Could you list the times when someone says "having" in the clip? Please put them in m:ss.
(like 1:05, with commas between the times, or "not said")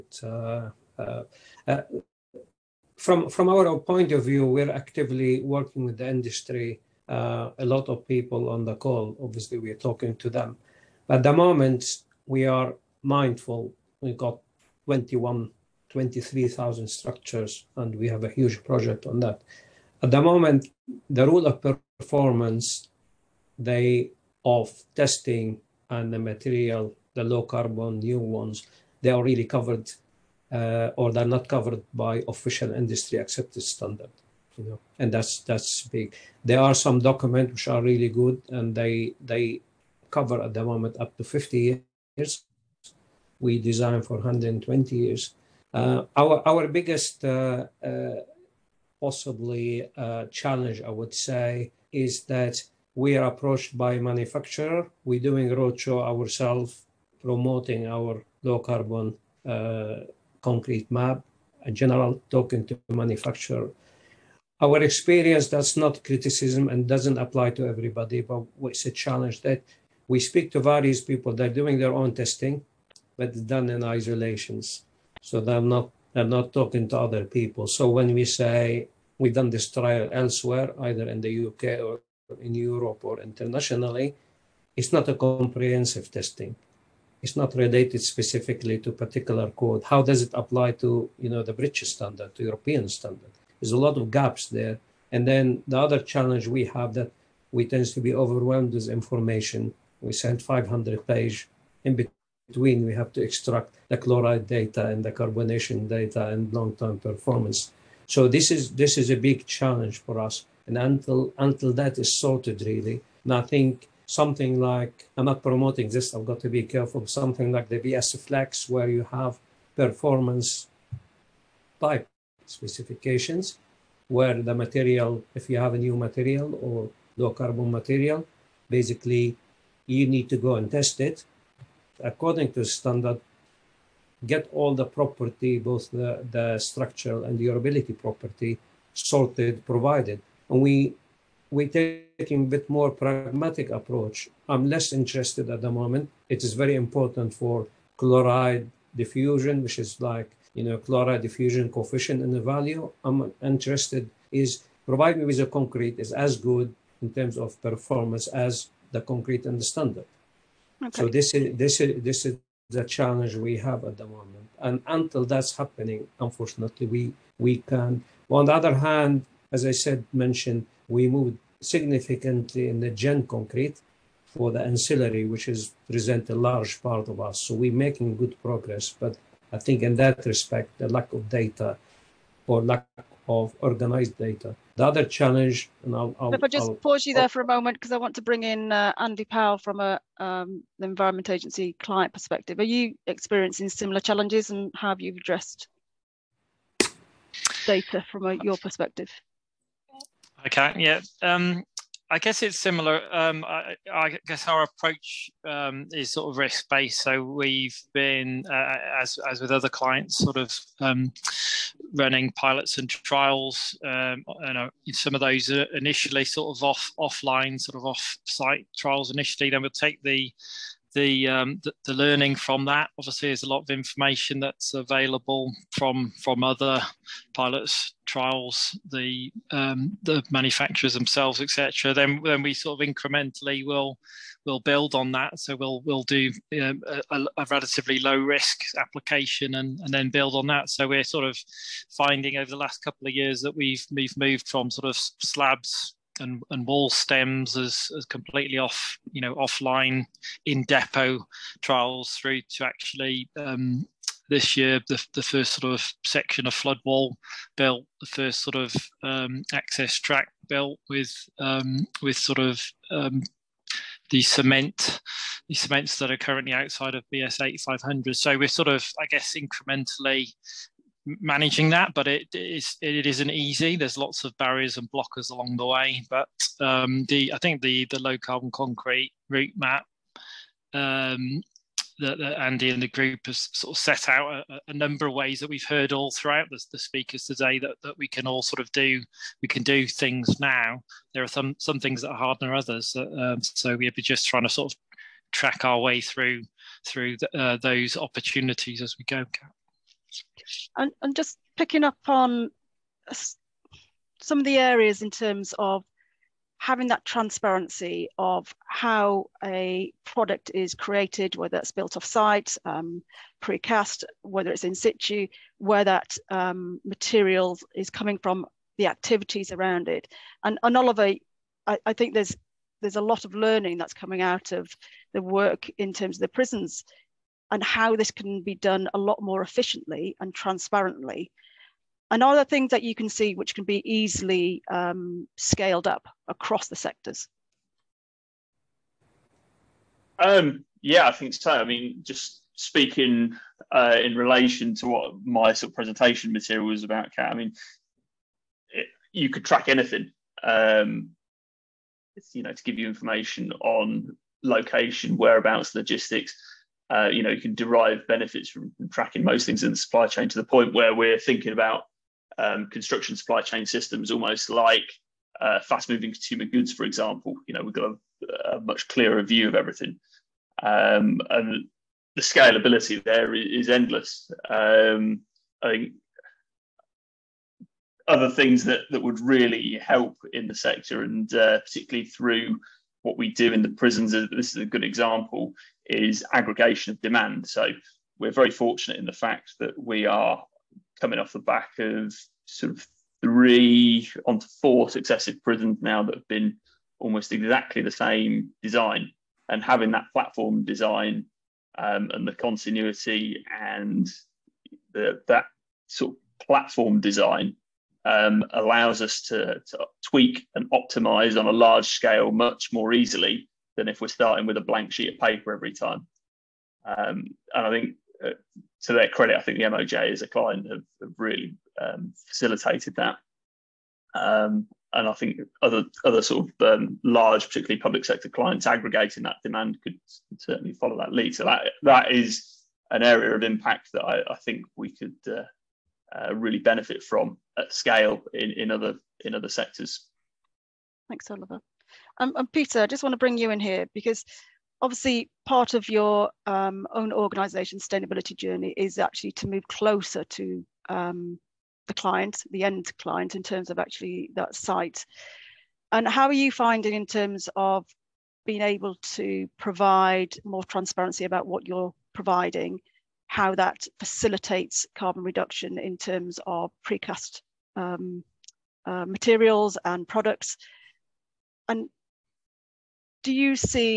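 5:06, 6:39.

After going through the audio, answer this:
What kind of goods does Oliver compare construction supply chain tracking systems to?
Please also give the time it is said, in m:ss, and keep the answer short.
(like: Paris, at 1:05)
Fast-moving consumer goods, at 6:05.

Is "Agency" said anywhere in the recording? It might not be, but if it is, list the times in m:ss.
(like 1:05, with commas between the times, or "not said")
3:11.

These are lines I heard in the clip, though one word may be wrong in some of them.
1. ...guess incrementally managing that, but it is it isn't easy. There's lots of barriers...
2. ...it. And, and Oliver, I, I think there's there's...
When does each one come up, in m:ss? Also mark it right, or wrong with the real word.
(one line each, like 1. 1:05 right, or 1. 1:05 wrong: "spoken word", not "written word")
1. 4:29 right
2. 5:19 right.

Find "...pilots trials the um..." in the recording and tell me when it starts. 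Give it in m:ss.
3:47.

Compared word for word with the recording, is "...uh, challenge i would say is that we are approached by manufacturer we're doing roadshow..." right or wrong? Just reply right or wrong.
right.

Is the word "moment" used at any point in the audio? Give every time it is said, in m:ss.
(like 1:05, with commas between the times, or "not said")
0:11, 0:20, 0:40, 2:25, 2:44, 3:07.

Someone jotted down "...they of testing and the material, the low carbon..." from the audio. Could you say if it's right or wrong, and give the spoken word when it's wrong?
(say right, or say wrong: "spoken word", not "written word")
right.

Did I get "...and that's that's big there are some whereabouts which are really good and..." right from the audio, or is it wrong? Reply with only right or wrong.
wrong.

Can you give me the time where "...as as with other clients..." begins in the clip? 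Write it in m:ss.
3:29.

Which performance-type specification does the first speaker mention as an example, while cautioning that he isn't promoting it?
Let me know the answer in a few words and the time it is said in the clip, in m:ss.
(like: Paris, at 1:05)
BS Flex, at 1:57.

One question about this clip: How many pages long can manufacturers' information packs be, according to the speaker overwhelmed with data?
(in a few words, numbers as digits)
500.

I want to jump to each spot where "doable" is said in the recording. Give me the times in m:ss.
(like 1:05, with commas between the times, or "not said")
not said.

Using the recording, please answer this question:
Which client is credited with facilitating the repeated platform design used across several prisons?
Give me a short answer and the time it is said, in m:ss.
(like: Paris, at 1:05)
MOJ, at 6:59.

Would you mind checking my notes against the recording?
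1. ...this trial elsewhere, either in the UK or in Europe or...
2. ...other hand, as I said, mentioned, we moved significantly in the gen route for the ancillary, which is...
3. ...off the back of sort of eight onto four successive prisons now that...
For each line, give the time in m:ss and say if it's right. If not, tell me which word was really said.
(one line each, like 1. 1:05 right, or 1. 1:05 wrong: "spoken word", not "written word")
1. 1:19 right
2. 2:48 wrong: "concrete", not "route"
3. 6:31 wrong: "three", not "eight".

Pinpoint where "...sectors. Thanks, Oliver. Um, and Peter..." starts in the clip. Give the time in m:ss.
7:19.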